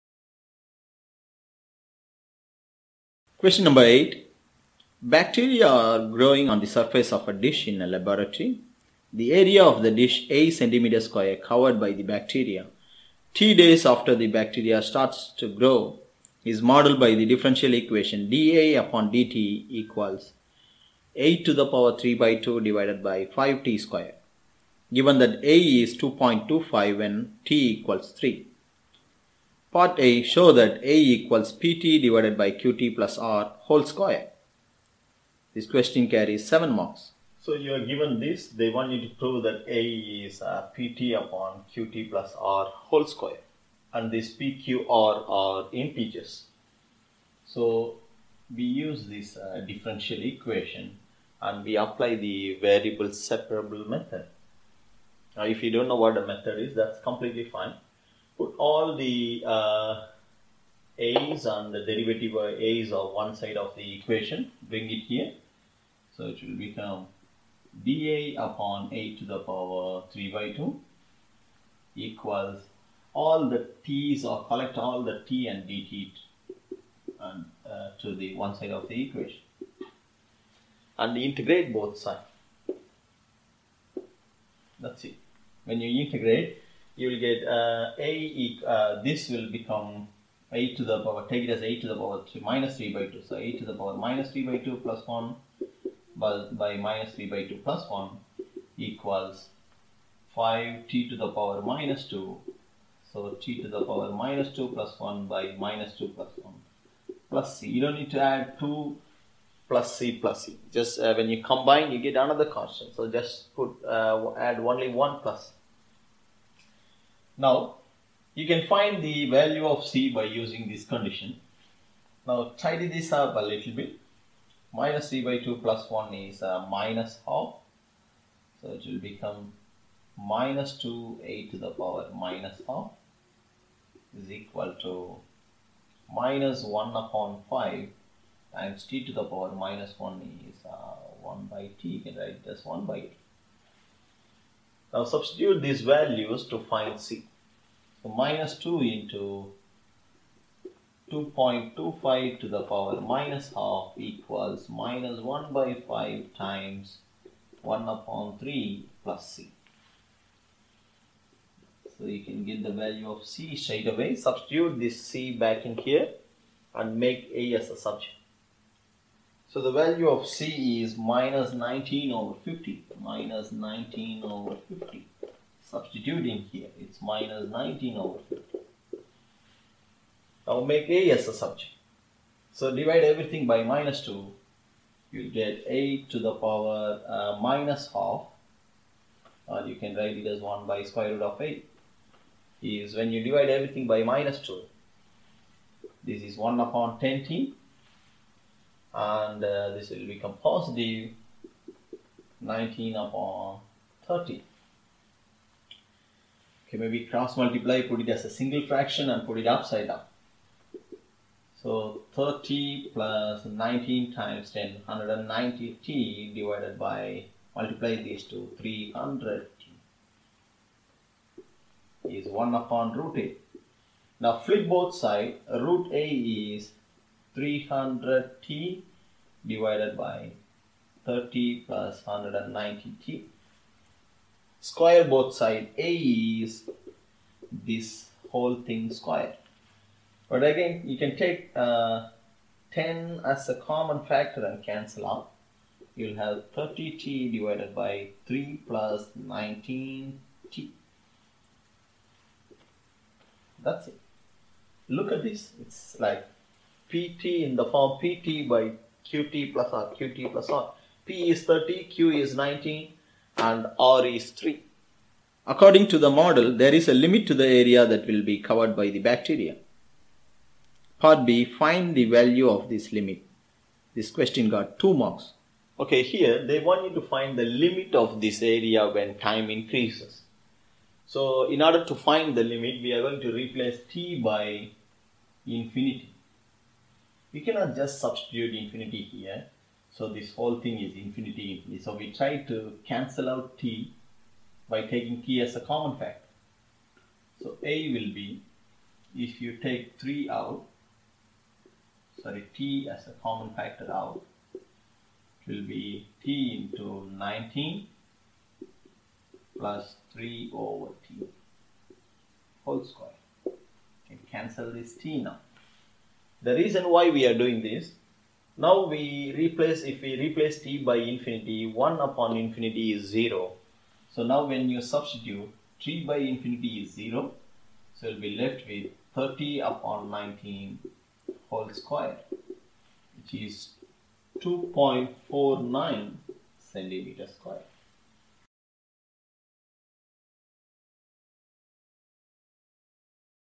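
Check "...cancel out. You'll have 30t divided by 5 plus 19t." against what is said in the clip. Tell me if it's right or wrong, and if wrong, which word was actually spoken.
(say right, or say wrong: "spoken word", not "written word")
wrong: "3", not "5".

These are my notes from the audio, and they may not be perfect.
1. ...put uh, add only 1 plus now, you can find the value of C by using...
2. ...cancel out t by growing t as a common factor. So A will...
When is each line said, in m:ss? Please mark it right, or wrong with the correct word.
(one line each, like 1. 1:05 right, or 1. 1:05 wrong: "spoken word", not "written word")
1. 1:53 right
2. 4:52 wrong: "taking", not "growing".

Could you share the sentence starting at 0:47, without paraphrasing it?
So we use this uh, differential equation and we apply the variable separable method.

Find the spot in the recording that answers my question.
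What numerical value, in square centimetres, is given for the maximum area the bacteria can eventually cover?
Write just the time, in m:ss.
5:34.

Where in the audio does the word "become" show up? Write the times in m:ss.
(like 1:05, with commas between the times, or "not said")
1:06, 1:29, 2:08, 3:20.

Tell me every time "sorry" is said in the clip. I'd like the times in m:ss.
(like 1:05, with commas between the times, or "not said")
5:02.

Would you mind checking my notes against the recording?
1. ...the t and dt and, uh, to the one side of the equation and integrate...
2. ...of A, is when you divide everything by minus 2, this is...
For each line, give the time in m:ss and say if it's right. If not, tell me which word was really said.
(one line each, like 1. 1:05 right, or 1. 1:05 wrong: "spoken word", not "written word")
1. 1:15 right
2. 3:11 right.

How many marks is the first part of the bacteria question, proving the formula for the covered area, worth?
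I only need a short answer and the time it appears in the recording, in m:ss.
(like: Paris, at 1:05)
7, at 0:36.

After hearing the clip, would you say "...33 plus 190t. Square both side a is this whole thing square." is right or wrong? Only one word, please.
wrong.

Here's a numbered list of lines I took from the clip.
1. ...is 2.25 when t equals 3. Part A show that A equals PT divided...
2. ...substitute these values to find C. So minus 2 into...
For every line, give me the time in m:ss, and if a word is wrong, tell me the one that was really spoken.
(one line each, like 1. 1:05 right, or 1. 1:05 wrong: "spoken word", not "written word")
1. 0:25 right
2. 2:25 right.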